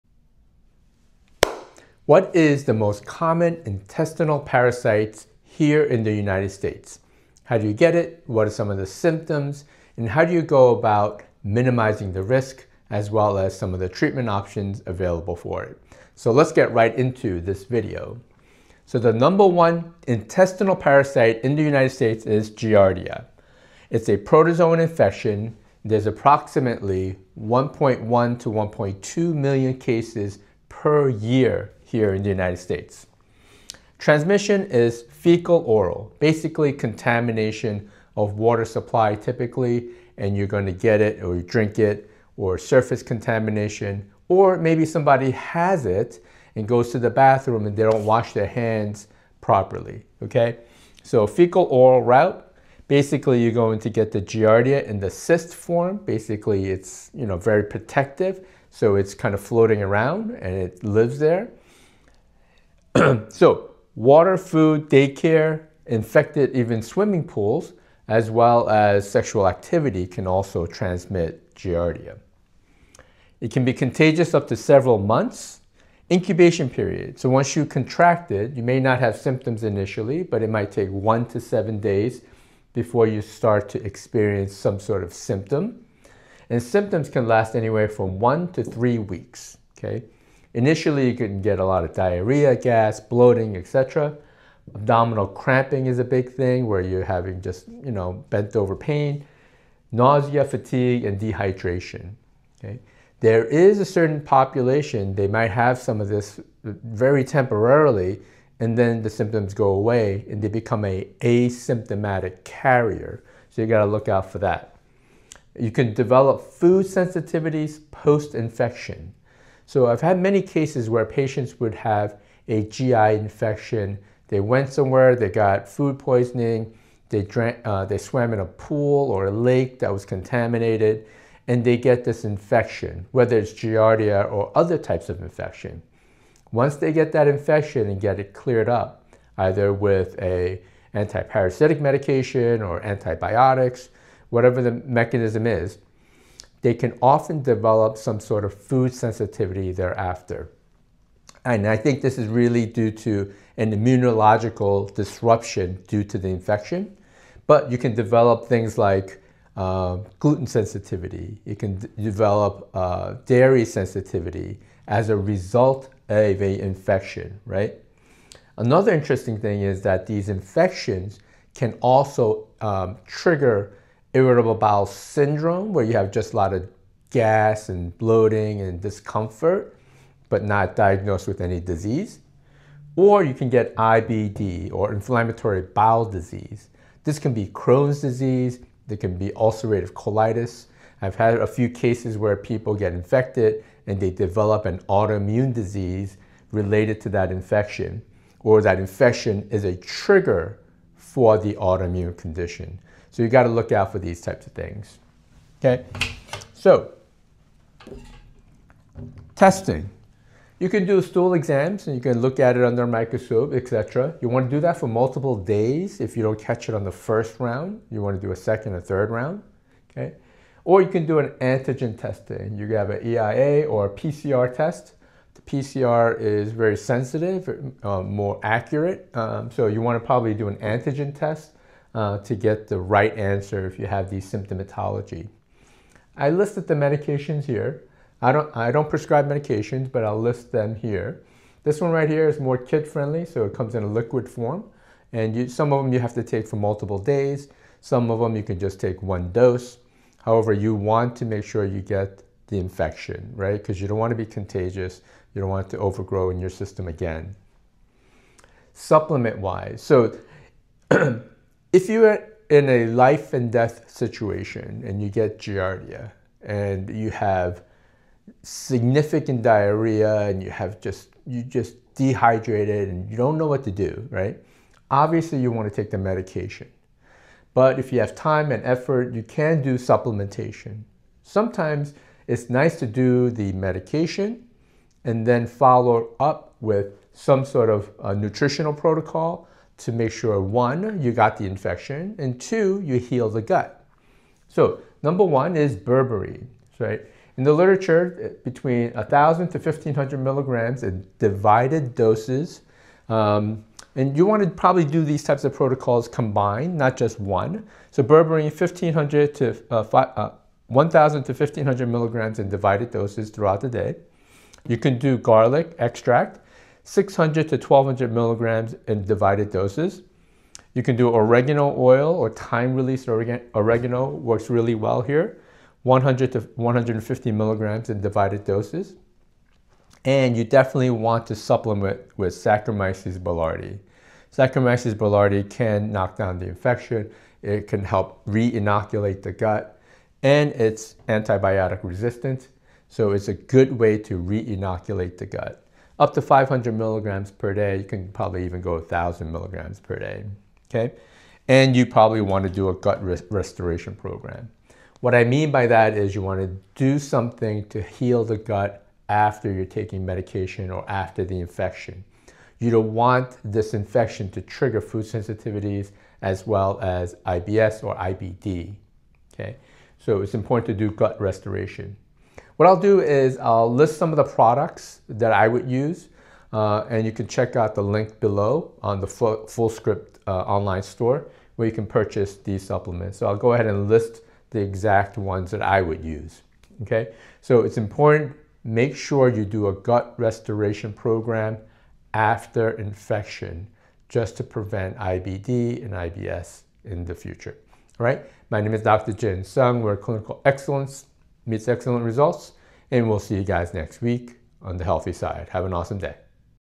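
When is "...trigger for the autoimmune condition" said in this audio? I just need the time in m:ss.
3:19.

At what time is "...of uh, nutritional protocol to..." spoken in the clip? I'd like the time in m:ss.
4:47.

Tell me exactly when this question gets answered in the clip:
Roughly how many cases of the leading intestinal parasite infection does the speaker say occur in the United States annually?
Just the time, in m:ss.
0:27.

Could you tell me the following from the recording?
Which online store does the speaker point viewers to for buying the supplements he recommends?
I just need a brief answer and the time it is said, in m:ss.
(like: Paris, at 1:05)
Fullscript, at 6:19.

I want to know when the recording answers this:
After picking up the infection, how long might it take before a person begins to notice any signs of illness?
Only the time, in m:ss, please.
1:20.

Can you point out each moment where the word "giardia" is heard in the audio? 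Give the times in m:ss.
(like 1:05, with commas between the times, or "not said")
0:22, 0:54, 1:11, 2:13, 4:25.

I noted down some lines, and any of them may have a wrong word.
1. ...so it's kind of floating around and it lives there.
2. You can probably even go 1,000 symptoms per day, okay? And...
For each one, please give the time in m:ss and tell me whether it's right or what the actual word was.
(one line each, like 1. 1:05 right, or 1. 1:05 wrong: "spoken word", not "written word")
1. 0:58 right
2. 5:47 wrong: "milligrams", not "symptoms".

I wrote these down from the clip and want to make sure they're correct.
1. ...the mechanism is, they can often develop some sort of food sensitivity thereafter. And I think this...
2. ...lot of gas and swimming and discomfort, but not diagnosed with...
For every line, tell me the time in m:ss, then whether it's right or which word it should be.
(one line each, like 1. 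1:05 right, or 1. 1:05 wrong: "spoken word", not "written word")
1. 2:24 right
2. 2:56 wrong: "bloating", not "swimming".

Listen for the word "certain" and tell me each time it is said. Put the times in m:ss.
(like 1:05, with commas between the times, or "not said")
1:43.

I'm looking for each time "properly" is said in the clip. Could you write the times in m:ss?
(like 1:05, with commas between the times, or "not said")
0:49.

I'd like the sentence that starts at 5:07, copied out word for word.
So berberine, 1,500 to uh, uh, 1,000 to 1,500 milligrams in divided doses throughout the day.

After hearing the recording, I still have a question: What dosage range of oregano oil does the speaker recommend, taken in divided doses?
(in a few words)
100 to 150 mg.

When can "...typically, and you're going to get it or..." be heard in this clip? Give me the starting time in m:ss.
0:39.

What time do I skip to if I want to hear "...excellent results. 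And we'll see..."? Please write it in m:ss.
6:41.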